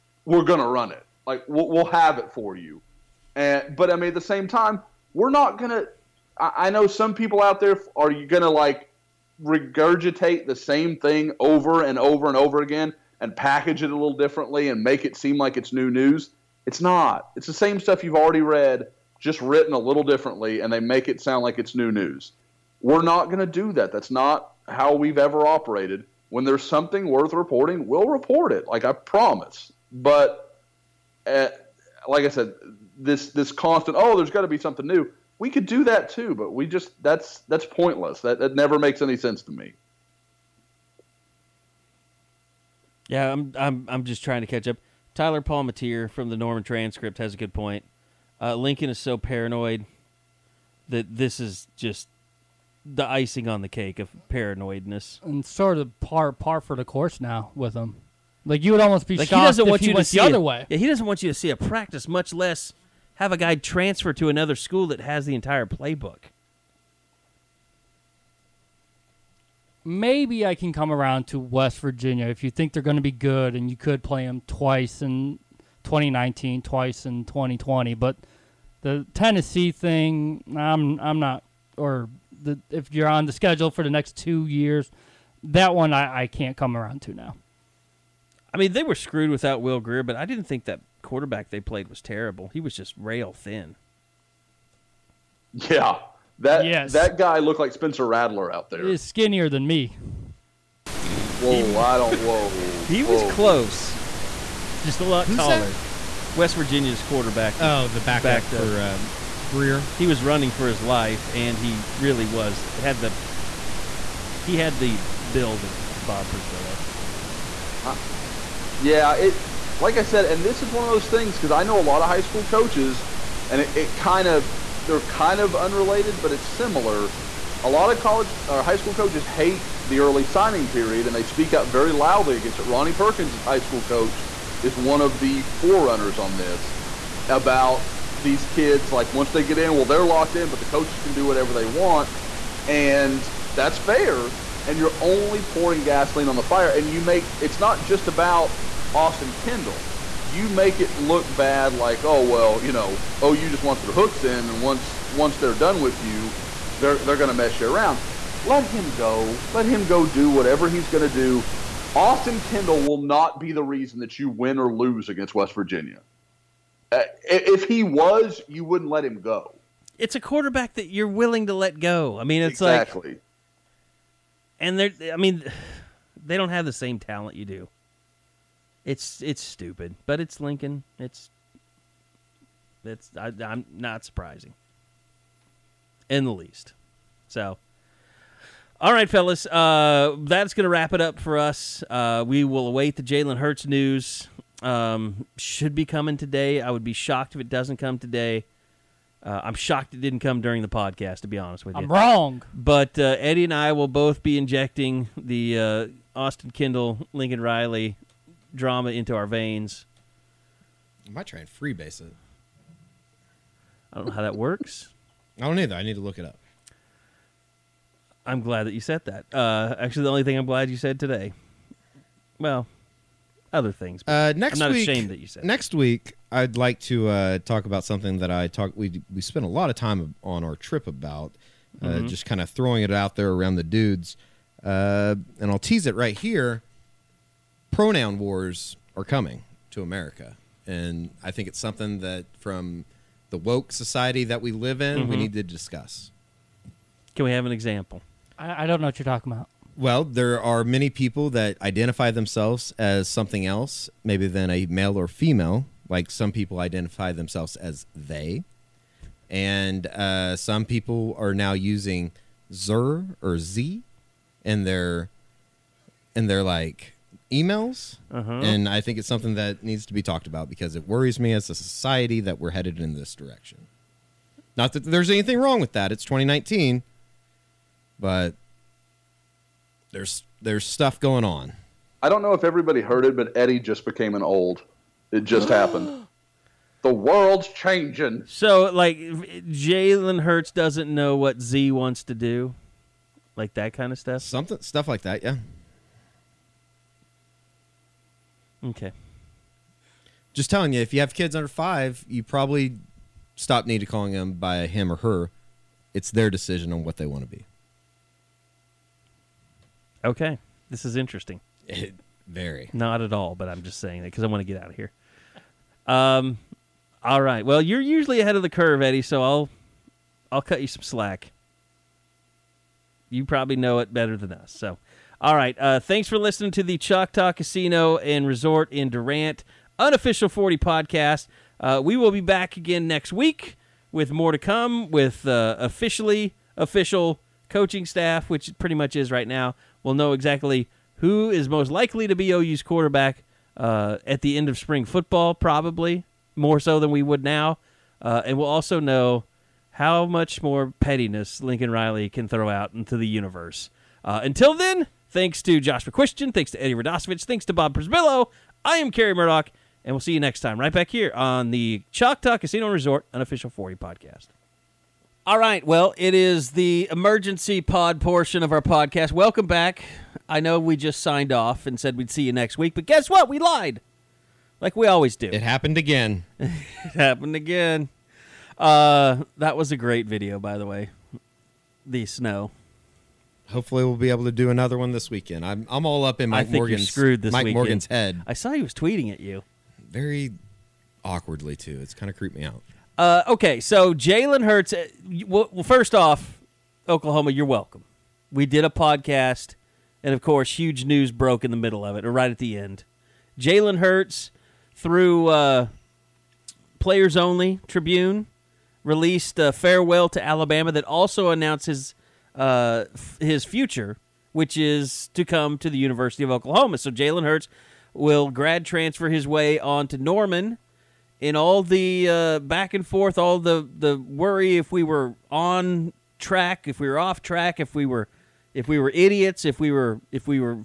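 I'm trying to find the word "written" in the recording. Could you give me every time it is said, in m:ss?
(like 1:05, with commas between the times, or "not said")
0:19.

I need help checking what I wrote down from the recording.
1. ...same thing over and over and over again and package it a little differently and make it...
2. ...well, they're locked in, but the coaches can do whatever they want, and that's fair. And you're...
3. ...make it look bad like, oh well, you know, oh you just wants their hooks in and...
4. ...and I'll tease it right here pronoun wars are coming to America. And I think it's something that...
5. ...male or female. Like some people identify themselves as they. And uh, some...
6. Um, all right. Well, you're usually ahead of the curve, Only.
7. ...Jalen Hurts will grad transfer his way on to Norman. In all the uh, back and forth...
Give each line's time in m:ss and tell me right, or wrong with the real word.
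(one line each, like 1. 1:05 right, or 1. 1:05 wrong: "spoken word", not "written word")
1. 0:10 right
2. 2:19 right
3. 2:30 right
4. 3:55 right
5. 4:14 right
6. 5:15 wrong: "Eddie", not "Only"
7. 6:56 right.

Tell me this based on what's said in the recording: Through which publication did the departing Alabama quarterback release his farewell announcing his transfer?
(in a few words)
Players Only Tribune.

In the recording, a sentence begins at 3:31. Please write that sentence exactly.
I might try and freebase it.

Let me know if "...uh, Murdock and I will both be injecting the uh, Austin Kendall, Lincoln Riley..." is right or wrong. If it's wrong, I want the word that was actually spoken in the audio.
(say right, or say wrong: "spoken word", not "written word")
wrong: "Eddie", not "Murdock".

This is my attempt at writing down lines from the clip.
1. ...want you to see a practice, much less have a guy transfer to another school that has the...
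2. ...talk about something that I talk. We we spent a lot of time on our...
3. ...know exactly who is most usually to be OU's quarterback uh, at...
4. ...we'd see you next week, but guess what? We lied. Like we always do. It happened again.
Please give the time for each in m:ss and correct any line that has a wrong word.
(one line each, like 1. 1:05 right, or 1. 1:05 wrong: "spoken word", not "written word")
1. 1:01 right
2. 3:47 right
3. 5:39 wrong: "likely", not "usually"
4. 6:11 right.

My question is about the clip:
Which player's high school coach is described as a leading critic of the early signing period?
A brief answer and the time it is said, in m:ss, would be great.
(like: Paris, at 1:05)
Ronnie Perkins, at 2:12.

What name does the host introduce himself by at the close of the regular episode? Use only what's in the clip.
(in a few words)
Carey Murdock.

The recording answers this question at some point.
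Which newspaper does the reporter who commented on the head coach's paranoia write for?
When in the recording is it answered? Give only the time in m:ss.
0:46.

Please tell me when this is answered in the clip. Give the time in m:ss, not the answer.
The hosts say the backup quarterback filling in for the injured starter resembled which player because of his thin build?
1:37.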